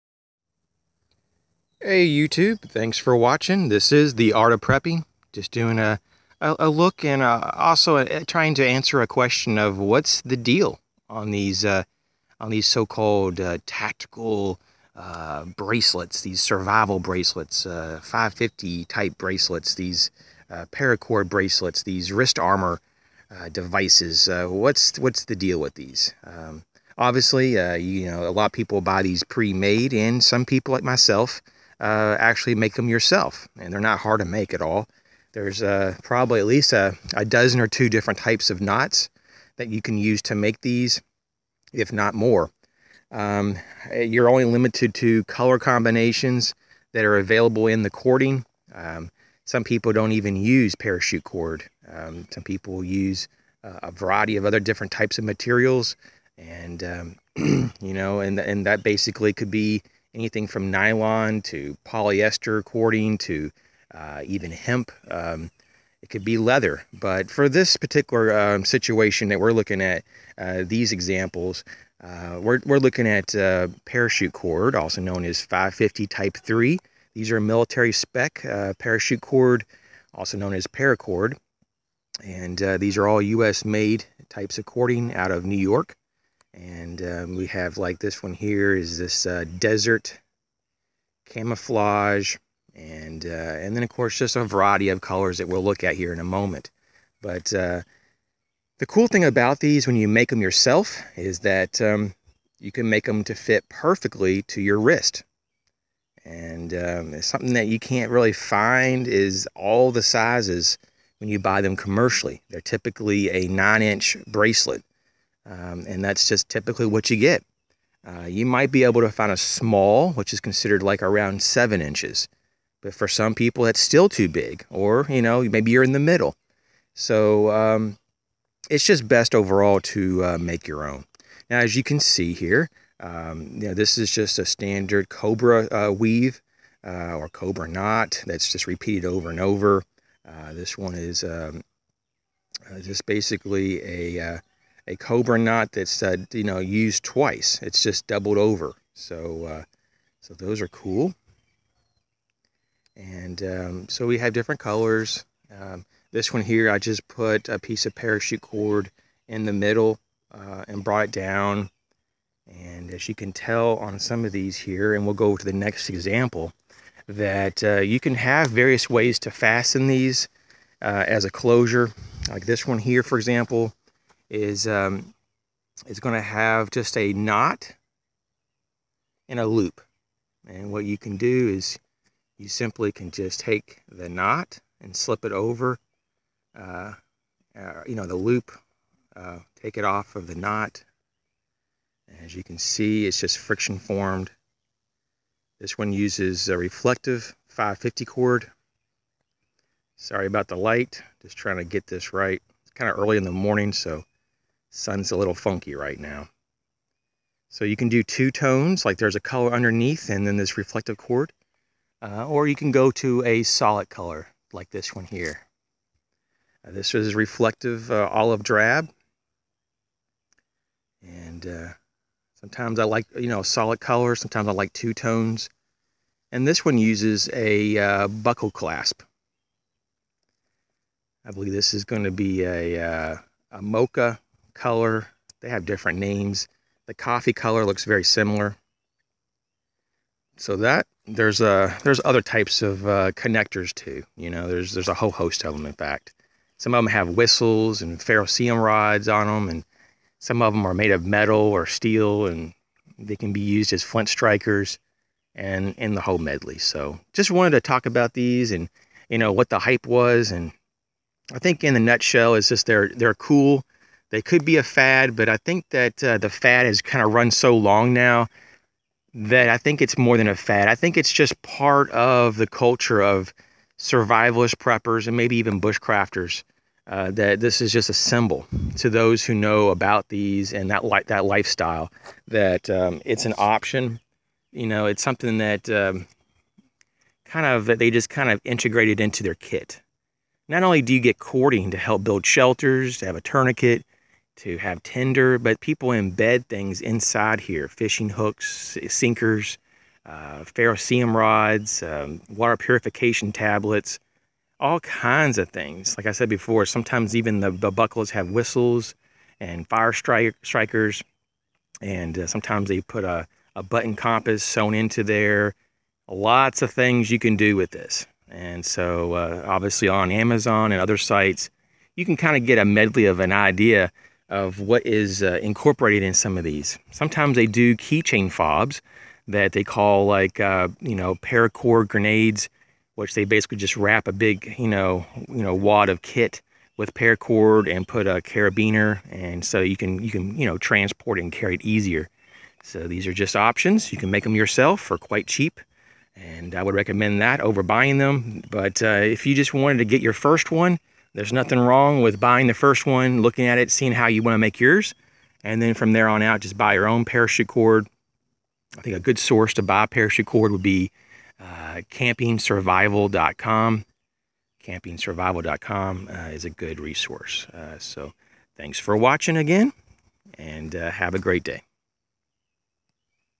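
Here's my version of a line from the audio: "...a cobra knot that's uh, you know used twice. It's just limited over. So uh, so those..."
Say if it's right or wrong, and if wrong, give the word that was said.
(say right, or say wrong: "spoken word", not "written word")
wrong: "doubled", not "limited".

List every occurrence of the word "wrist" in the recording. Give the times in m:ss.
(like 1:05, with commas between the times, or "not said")
0:22, 1:44.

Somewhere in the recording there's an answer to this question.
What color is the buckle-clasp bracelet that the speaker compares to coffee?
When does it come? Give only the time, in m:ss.
3:53.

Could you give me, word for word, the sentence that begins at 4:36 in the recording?
Uh, that this is just a symbol to those who know about these and that li- that lifestyle.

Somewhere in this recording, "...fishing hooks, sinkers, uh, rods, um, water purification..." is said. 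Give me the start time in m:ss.
4:57.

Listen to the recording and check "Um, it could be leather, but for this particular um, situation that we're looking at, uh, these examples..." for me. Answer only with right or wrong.
right.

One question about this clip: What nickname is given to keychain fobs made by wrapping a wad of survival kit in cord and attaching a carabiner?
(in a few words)
Paracord grenades.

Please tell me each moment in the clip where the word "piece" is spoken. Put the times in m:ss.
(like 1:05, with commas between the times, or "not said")
2:37.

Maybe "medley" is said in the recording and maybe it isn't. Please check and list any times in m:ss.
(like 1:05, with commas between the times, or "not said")
4:16, 5:22.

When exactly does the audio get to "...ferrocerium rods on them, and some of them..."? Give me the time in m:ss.
4:07.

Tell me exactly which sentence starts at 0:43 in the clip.
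Um, you're only limited to color combinations that are available in the cording.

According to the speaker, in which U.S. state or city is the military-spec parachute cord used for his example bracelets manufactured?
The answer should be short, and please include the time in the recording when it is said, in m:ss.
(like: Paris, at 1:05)
New York, at 1:25.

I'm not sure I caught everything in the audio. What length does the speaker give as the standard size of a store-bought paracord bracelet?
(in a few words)
9 inches.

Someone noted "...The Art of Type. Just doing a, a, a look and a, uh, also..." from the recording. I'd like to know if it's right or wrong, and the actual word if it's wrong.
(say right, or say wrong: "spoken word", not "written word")
wrong: "Prepping", not "Type".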